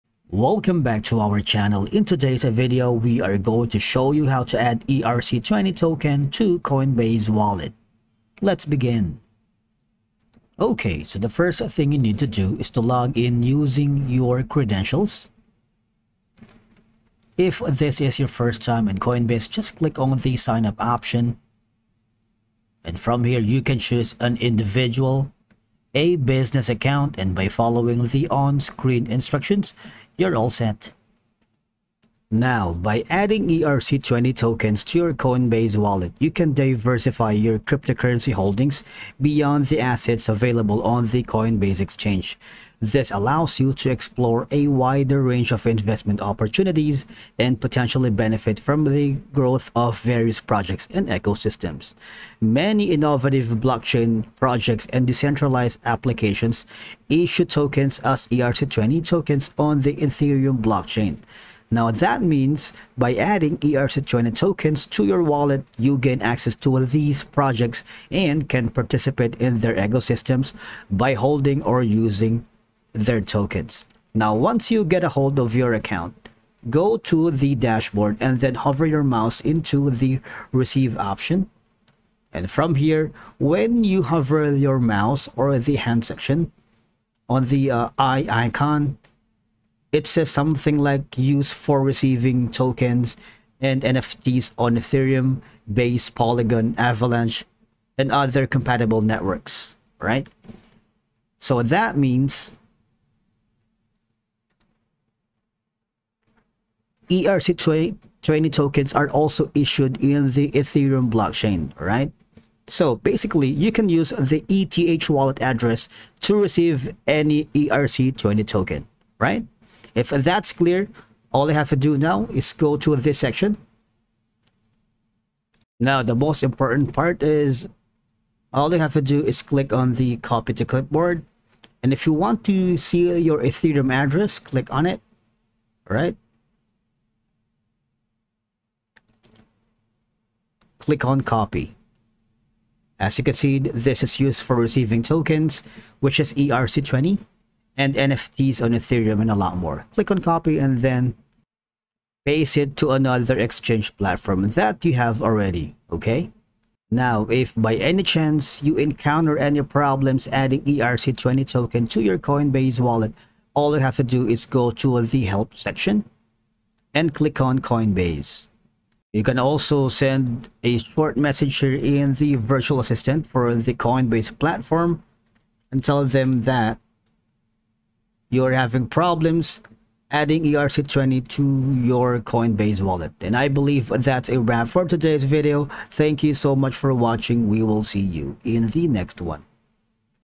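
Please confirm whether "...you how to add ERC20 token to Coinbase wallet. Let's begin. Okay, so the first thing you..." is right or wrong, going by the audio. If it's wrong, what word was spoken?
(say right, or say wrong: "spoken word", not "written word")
right.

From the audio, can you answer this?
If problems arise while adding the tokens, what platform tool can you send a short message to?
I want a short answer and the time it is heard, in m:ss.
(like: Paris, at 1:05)
virtual assistant, at 2:52.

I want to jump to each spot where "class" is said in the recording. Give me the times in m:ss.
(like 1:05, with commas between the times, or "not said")
not said.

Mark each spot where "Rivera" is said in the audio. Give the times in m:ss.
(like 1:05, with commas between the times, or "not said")
not said.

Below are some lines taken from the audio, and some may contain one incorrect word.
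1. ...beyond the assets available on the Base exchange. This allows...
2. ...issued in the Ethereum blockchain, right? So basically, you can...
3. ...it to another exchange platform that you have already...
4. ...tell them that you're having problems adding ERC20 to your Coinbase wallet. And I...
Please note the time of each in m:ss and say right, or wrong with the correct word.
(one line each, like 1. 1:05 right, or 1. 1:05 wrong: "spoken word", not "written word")
1. 0:39 wrong: "Coinbase", not "Base"
2. 1:49 right
3. 2:32 right
4. 2:55 right.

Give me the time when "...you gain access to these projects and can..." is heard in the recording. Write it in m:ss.
1:05.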